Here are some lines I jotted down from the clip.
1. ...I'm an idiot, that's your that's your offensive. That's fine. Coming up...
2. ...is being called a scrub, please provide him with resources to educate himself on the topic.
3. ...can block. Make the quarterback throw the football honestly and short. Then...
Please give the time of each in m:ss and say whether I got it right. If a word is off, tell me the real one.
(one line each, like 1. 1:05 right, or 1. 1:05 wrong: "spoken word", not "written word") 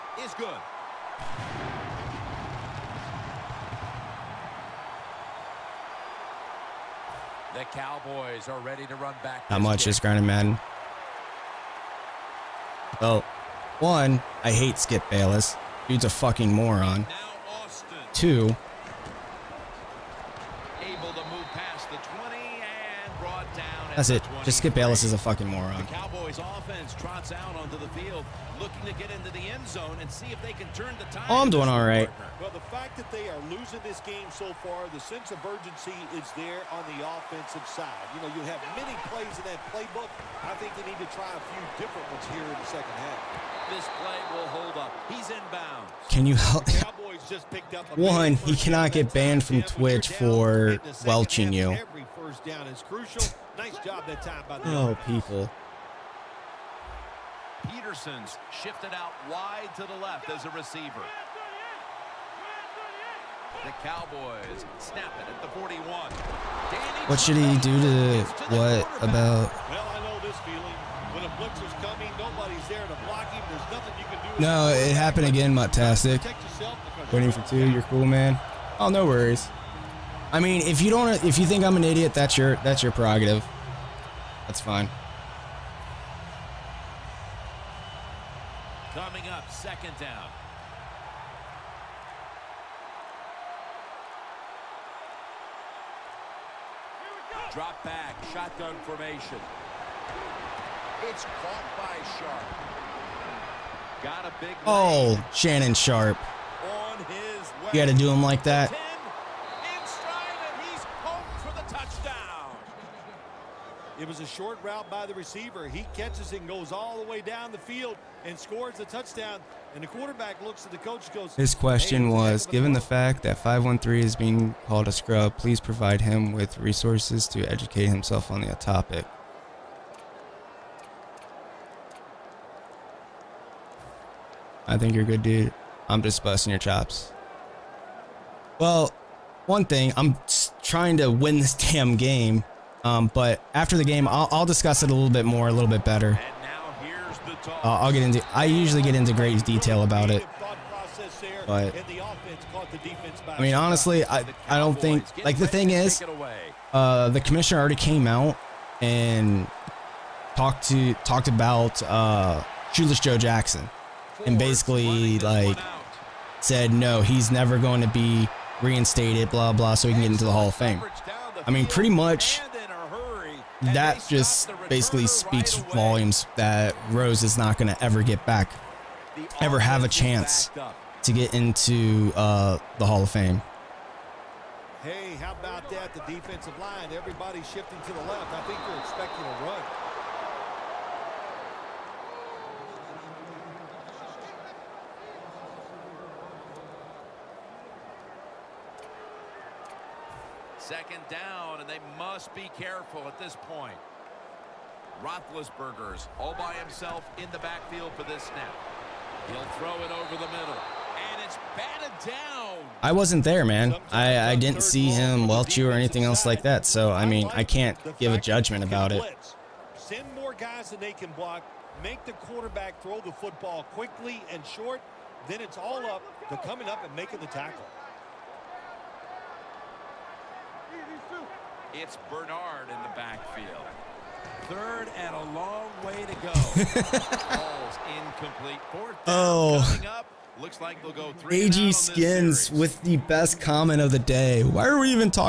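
1. 1:21 wrong: "prerogative", not "offensive"
2. 2:04 right
3. 3:40 wrong: "quickly", not "honestly".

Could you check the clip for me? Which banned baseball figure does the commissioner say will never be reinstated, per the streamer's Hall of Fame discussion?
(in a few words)
Shoeless Joe Jackson.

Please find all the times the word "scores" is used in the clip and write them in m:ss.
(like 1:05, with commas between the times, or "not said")
1:58.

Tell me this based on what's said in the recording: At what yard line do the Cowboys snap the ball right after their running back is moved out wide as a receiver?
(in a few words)
41.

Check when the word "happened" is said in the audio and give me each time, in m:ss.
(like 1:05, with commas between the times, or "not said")
1:14.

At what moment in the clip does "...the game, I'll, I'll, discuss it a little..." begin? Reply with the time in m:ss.
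2:23.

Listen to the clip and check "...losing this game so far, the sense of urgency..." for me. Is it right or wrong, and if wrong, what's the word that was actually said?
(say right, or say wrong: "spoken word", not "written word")
right.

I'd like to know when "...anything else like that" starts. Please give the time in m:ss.
3:35.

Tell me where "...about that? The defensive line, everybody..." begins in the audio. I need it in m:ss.
3:05.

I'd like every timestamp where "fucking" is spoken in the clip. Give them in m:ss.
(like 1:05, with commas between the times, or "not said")
0:16, 0:25.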